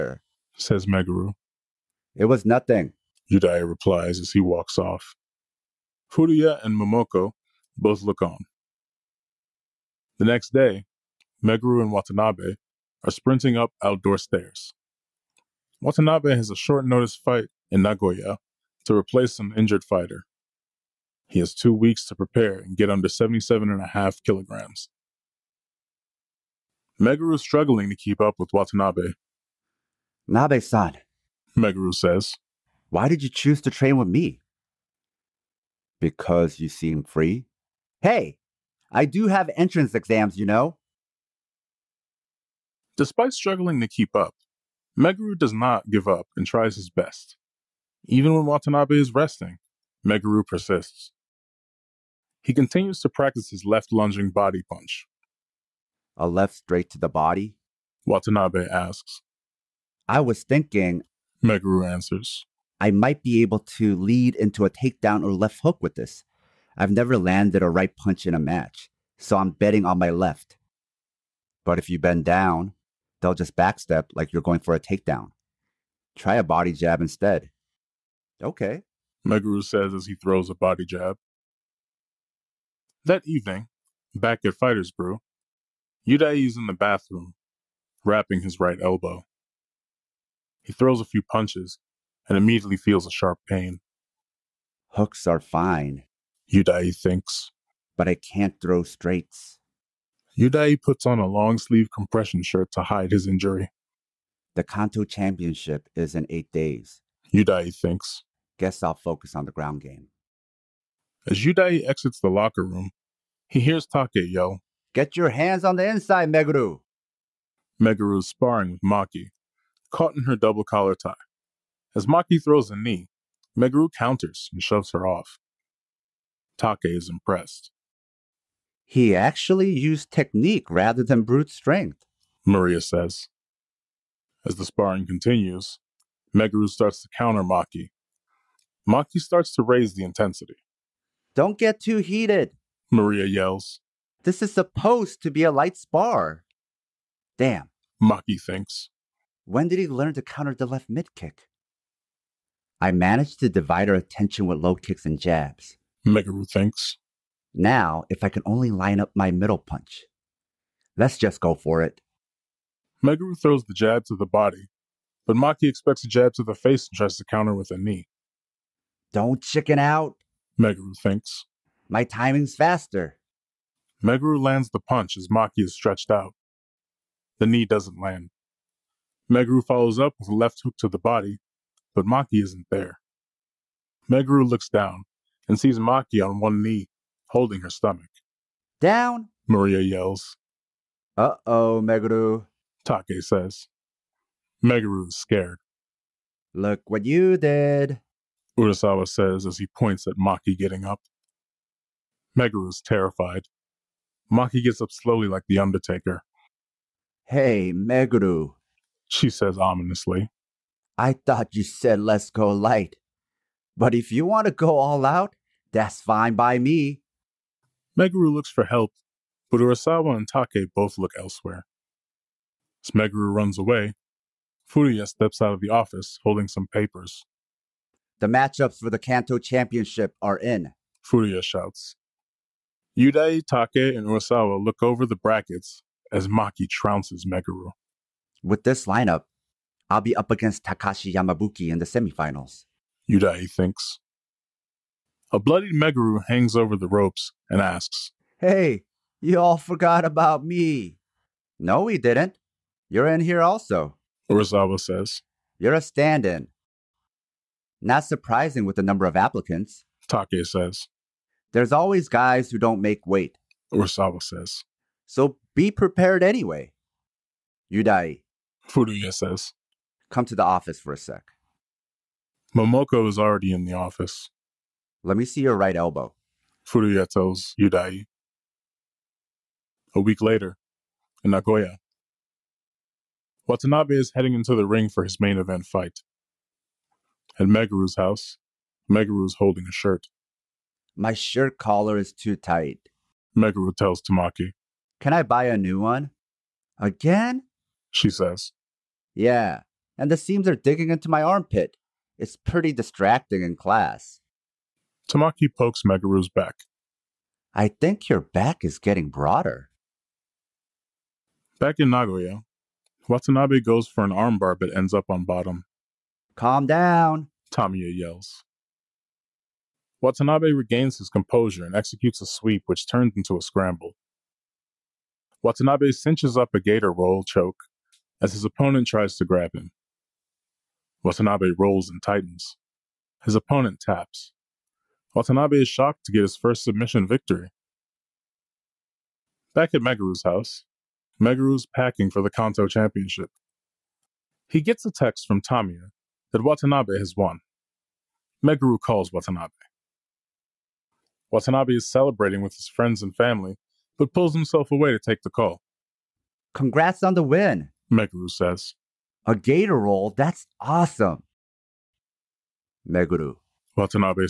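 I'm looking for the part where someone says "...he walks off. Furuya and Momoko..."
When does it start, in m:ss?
0:04.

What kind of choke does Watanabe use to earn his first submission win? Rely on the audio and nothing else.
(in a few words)
Gator roll choke.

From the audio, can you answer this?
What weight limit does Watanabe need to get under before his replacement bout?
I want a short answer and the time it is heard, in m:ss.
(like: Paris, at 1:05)
77.5 kilograms, at 0:23.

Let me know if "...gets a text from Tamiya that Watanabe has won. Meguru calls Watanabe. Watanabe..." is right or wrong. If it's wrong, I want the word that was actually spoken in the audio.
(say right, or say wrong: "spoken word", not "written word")
right.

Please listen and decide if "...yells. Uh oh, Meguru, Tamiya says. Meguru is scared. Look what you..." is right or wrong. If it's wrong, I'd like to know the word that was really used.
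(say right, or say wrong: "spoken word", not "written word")
wrong: "Take", not "Tamiya".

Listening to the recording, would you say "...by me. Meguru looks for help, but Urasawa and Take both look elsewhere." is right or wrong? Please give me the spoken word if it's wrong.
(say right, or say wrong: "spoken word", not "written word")
right.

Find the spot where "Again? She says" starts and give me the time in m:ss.
4:56.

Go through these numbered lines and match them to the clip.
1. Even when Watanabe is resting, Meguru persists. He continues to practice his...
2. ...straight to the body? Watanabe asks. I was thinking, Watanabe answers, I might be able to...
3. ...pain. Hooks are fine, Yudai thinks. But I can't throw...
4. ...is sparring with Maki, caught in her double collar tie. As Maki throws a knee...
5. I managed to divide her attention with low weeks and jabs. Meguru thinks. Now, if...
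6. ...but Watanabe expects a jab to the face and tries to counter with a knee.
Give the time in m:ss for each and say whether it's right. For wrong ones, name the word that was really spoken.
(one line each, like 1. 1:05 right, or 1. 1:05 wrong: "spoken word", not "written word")
1. 0:48 right
2. 0:56 wrong: "Meguru", not "Watanabe"
3. 1:33 right
4. 1:58 right
5. 2:32 wrong: "kicks", not "weeks"
6. 2:45 wrong: "Maki", not "Watanabe".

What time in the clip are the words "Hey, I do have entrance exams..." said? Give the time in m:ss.
0:38.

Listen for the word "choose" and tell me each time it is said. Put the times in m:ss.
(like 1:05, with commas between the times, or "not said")
0:33.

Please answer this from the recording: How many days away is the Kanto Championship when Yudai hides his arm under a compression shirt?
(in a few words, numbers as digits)
8.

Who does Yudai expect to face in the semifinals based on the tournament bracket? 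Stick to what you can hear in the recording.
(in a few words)
Takashi Yamabuki.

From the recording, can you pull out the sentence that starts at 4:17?
Not surprising with the number of applicants.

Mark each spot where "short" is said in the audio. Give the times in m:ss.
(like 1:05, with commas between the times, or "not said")
0:16.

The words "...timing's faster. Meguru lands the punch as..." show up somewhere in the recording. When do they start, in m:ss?
2:52.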